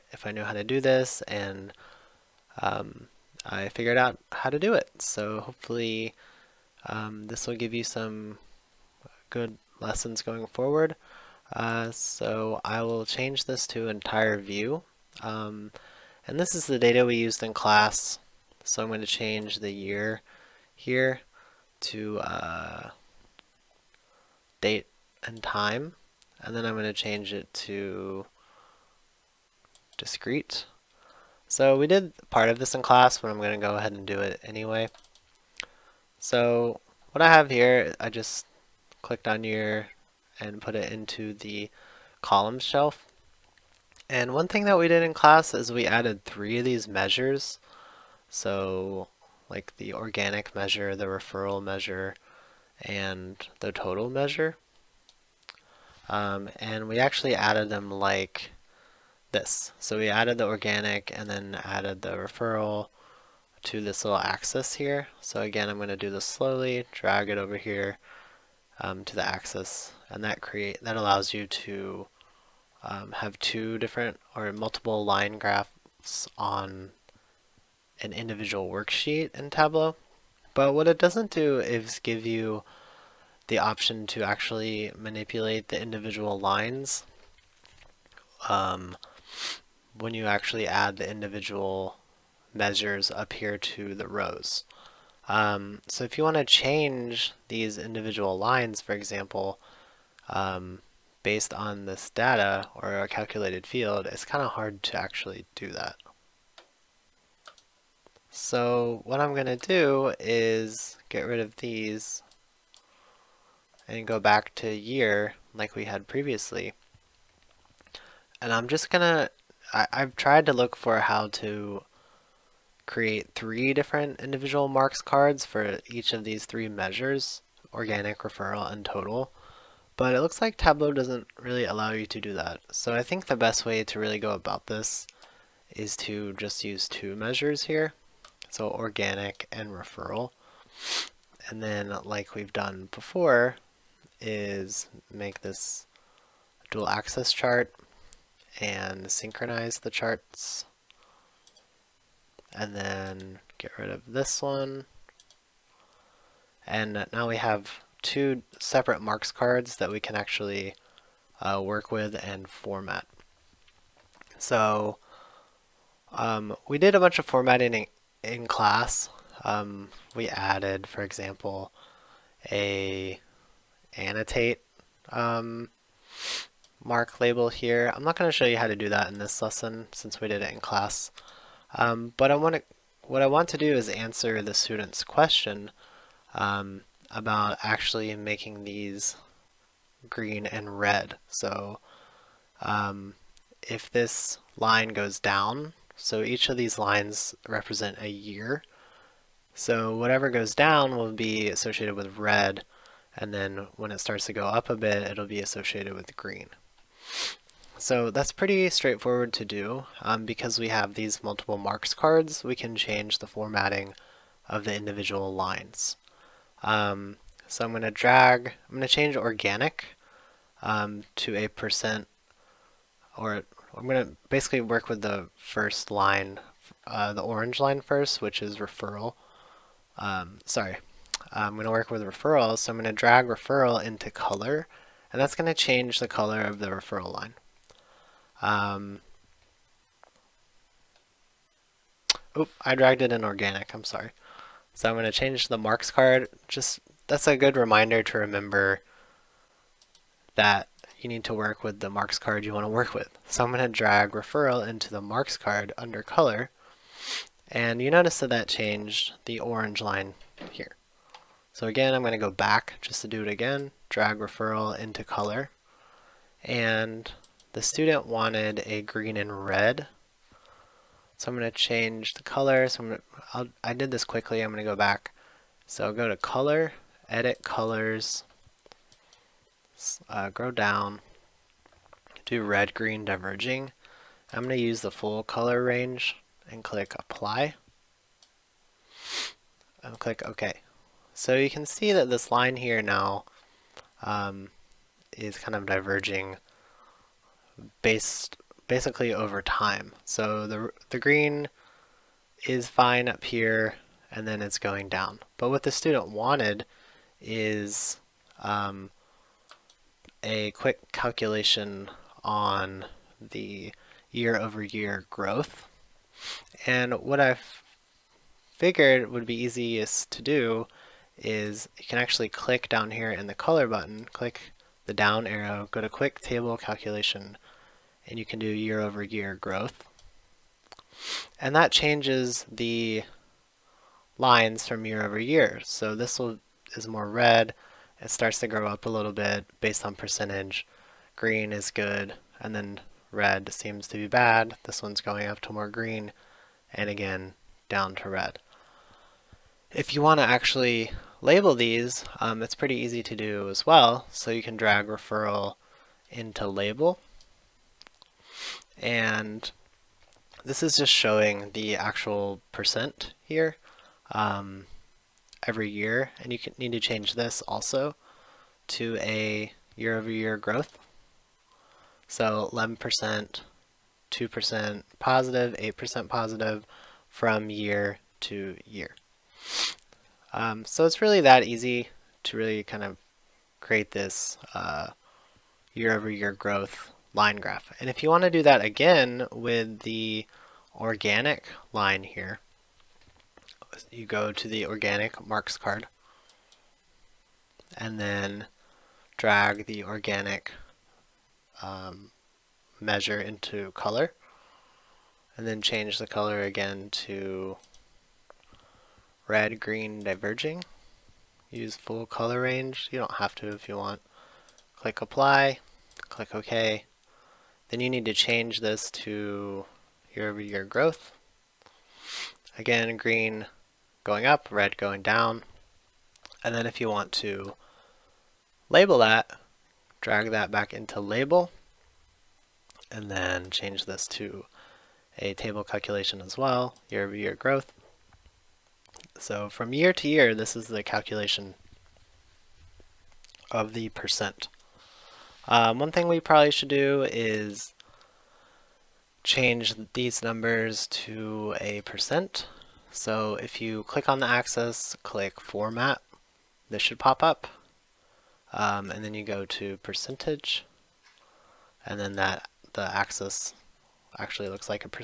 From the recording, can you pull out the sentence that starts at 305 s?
But what the student wanted is um, a quick calculation on the year over year growth.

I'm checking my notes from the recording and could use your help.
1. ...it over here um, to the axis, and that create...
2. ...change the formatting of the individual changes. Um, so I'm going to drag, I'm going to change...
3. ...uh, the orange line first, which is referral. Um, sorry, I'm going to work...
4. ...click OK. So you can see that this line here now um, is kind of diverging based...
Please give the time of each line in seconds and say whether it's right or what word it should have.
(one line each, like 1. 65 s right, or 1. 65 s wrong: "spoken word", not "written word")
1. 67 s right
2. 212 s wrong: "lines", not "changes"
3. 226 s right
4. 290 s right.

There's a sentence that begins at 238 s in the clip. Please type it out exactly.
Um, oop, I dragged it in organic, I'm sorry.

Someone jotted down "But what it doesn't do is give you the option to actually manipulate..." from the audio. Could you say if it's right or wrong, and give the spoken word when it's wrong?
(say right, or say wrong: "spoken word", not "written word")
right.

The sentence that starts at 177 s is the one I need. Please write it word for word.
I'm not going to show you how to do that in this lesson since we did it in class.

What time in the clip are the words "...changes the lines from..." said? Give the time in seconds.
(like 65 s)
331 s.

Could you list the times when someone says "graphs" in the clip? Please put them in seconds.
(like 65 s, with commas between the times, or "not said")
75 s, 387 s.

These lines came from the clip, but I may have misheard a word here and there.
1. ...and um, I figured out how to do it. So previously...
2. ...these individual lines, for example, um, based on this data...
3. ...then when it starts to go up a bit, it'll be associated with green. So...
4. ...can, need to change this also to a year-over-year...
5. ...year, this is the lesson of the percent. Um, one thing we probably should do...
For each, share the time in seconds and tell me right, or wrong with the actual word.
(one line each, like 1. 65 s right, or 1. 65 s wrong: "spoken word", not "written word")
1. 1 s wrong: "hopefully", not "previously"
2. 97 s right
3. 203 s right
4. 366 s right
5. 440 s wrong: "calculation", not "lesson".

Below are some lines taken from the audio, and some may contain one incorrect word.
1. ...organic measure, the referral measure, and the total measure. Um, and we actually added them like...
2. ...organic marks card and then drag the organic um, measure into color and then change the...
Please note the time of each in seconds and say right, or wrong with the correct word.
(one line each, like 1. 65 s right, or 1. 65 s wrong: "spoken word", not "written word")
1. 49 s right
2. 394 s right.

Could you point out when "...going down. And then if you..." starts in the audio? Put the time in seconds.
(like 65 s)
424 s.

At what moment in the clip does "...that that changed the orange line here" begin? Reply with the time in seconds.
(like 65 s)
258 s.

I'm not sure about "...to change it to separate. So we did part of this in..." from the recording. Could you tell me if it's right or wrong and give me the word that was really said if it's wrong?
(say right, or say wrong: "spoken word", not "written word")
wrong: "discrete", not "separate".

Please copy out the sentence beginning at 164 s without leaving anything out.
So um, we did a bunch of formatting in, in class.